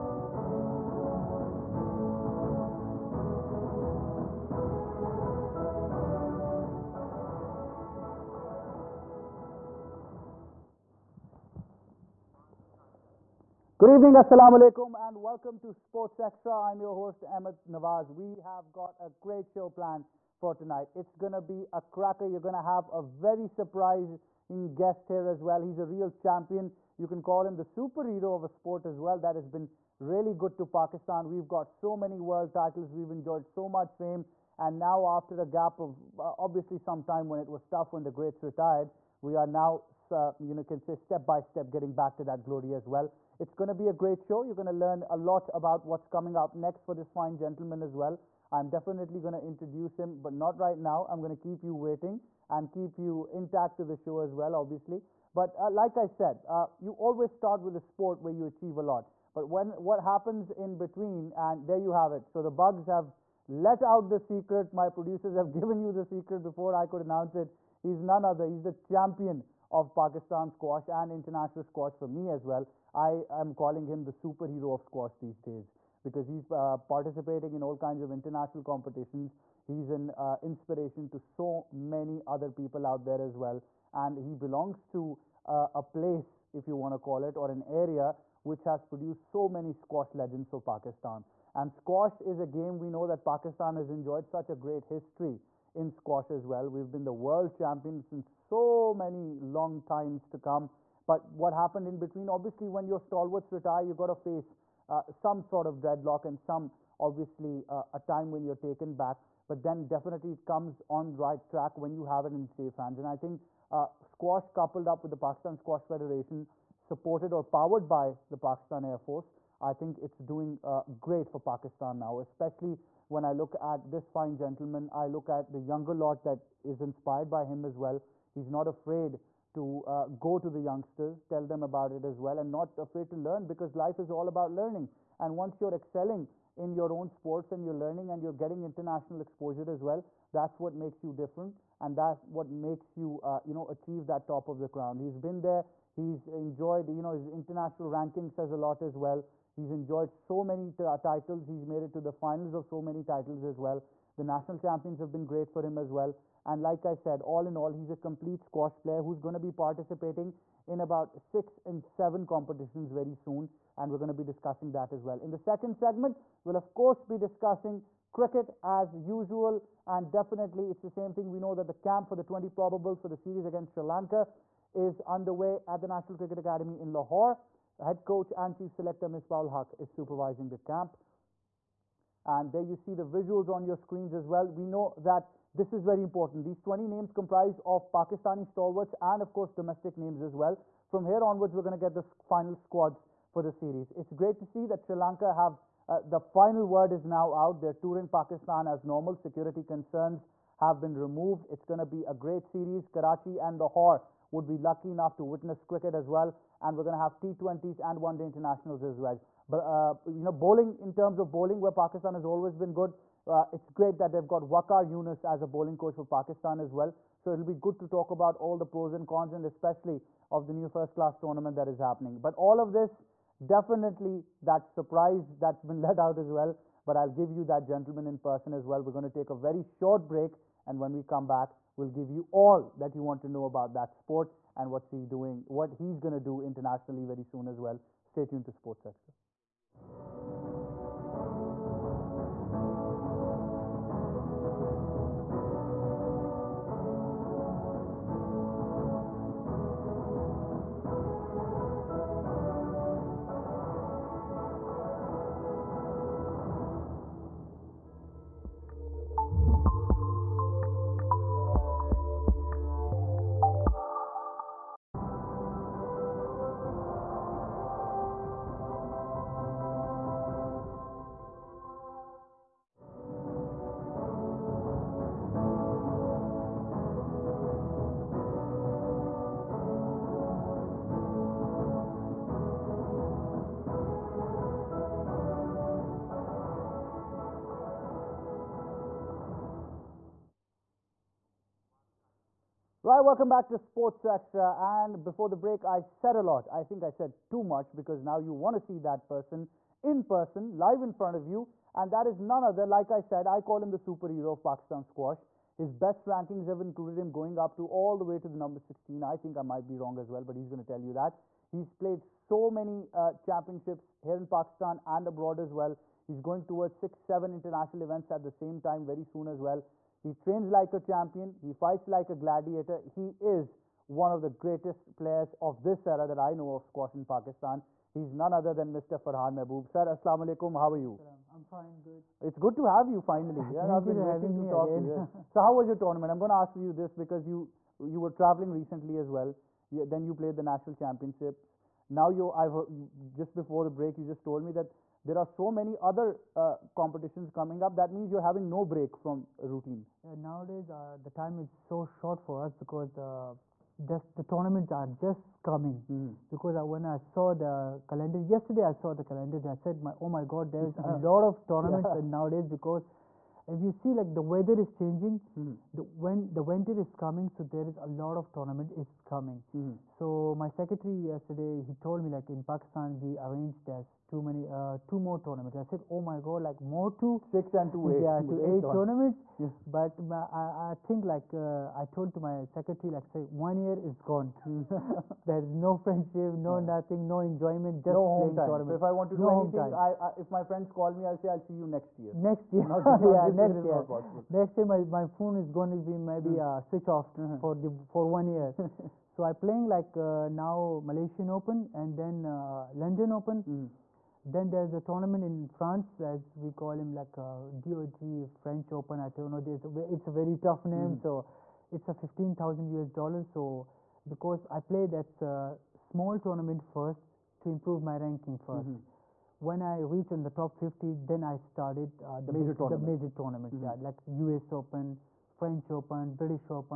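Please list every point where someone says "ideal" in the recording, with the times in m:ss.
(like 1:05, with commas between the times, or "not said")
not said.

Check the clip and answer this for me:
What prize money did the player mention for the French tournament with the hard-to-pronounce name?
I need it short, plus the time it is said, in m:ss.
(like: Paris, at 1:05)
$15,000, at 6:52.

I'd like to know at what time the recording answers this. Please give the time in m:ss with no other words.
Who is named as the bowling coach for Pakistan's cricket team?
3:34.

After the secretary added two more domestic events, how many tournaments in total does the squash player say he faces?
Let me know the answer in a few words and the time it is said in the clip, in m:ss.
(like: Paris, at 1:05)
8, at 6:18.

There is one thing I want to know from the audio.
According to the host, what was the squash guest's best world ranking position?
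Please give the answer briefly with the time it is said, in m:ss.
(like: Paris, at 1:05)
16, at 5:08.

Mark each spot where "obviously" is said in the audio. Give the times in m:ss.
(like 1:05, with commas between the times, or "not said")
0:36, 0:54, 1:42, 1:46.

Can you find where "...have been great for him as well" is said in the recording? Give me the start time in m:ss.
2:34.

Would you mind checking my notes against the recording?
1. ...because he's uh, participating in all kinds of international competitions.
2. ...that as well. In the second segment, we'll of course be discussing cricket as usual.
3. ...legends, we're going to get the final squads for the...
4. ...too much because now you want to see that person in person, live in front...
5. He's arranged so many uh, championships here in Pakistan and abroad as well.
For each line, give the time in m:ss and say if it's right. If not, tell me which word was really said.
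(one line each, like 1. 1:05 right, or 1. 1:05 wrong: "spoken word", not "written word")
1. 1:16 right
2. 2:44 right
3. 3:11 wrong: "onwards", not "legends"
4. 4:57 right
5. 5:11 wrong: "played", not "arranged".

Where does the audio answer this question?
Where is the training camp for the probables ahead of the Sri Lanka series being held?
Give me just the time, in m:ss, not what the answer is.
2:55.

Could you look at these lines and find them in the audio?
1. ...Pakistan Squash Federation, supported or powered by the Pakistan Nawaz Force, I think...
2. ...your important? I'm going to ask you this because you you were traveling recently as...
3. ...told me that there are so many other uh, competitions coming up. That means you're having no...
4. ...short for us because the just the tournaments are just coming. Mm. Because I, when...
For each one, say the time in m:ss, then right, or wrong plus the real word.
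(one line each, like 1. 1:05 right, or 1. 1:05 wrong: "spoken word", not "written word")
1. 1:55 wrong: "Air", not "Nawaz"
2. 5:35 wrong: "tournament", not "important"
3. 5:44 right
4. 5:51 right.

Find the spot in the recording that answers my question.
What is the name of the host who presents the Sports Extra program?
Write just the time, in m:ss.
0:17.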